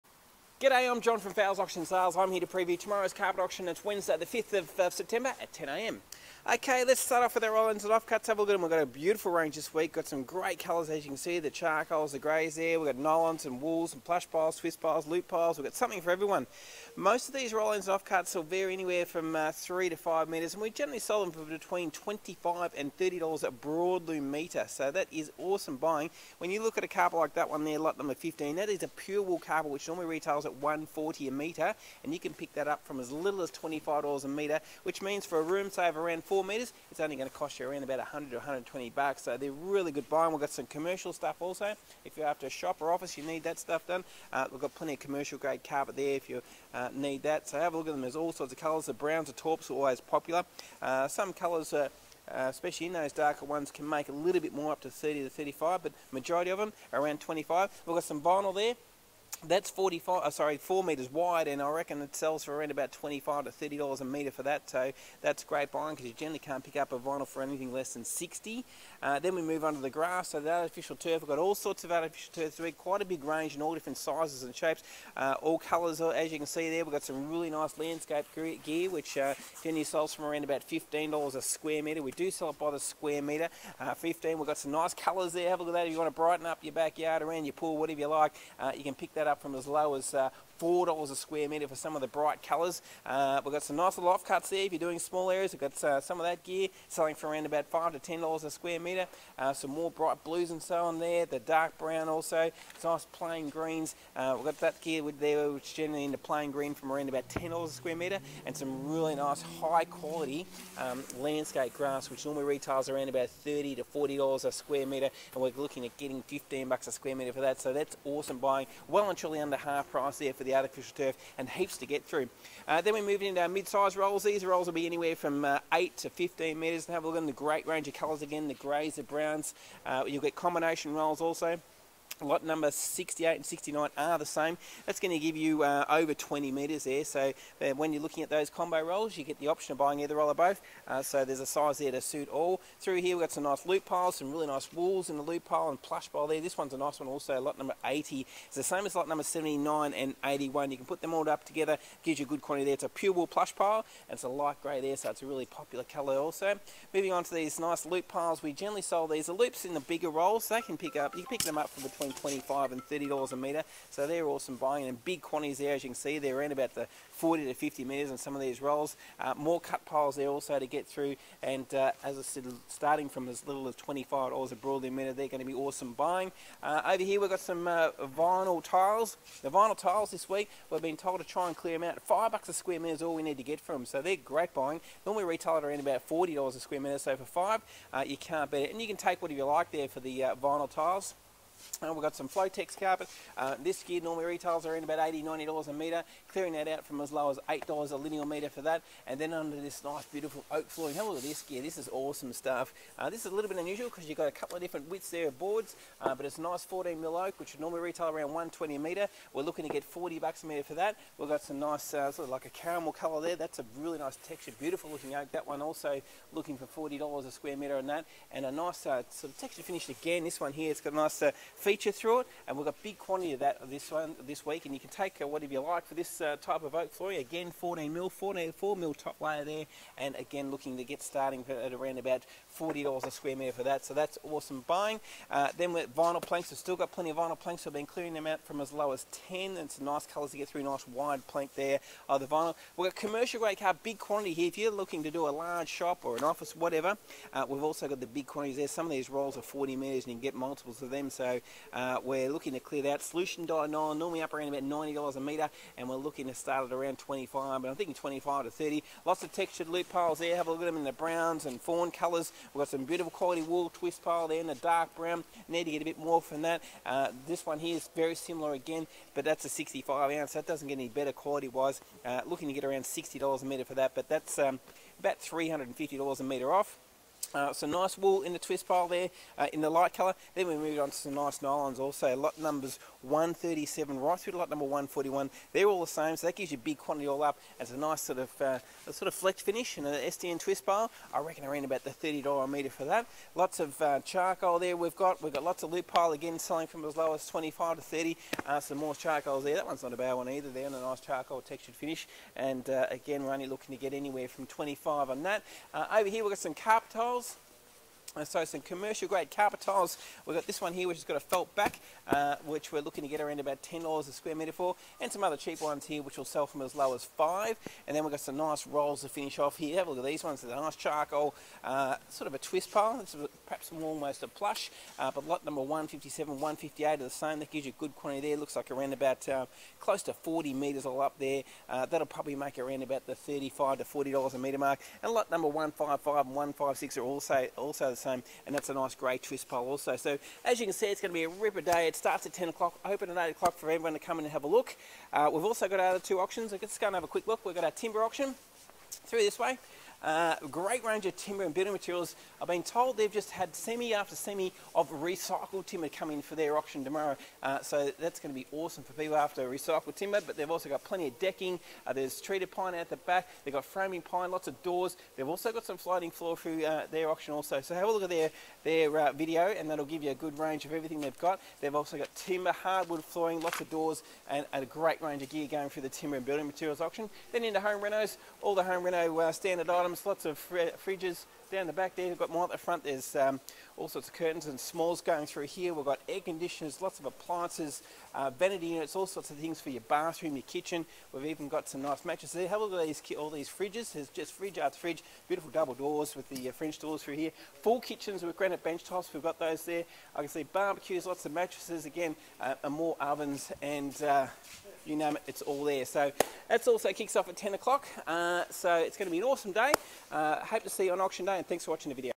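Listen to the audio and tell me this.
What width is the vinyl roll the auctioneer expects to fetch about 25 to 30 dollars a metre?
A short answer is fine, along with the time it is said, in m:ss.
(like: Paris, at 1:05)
4 metres, at 1:00.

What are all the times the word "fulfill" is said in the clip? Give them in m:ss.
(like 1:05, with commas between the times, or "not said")
not said.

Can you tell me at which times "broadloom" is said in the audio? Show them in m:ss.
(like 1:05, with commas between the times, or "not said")
0:23, 2:54.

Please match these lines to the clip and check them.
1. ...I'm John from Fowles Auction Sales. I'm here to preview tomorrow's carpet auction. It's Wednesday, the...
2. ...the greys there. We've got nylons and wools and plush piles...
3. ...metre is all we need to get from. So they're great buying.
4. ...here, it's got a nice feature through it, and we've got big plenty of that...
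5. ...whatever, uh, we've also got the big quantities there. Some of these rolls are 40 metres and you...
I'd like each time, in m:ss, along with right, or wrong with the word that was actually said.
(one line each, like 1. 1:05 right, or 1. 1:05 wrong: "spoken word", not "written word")
1. 0:00 right
2. 0:12 right
3. 3:02 right
4. 3:40 wrong: "quantity", not "plenty"
5. 4:06 right.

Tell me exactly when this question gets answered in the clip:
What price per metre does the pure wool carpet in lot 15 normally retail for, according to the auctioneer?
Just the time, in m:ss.
0:30.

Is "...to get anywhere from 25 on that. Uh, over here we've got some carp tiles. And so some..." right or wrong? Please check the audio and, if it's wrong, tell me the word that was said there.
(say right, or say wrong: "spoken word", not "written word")
right.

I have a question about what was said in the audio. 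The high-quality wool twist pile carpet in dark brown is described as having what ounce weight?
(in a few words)
65 ounce.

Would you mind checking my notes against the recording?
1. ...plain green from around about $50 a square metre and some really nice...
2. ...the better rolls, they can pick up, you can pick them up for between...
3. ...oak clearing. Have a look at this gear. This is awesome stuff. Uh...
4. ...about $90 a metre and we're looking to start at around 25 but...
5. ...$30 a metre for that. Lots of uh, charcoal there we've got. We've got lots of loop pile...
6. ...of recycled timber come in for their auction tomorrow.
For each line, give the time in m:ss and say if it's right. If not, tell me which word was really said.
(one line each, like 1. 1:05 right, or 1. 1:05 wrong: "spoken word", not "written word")
1. 1:46 wrong: "10", not "50"
2. 2:39 wrong: "bigger", not "better"
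3. 3:20 wrong: "flooring", not "clearing"
4. 4:14 right
5. 4:51 right
6. 5:54 right.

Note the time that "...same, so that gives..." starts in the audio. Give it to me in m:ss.
4:45.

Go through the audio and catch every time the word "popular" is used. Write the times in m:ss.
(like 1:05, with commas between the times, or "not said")
0:49, 2:35.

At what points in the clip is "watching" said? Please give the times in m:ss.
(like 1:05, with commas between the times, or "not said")
6:51.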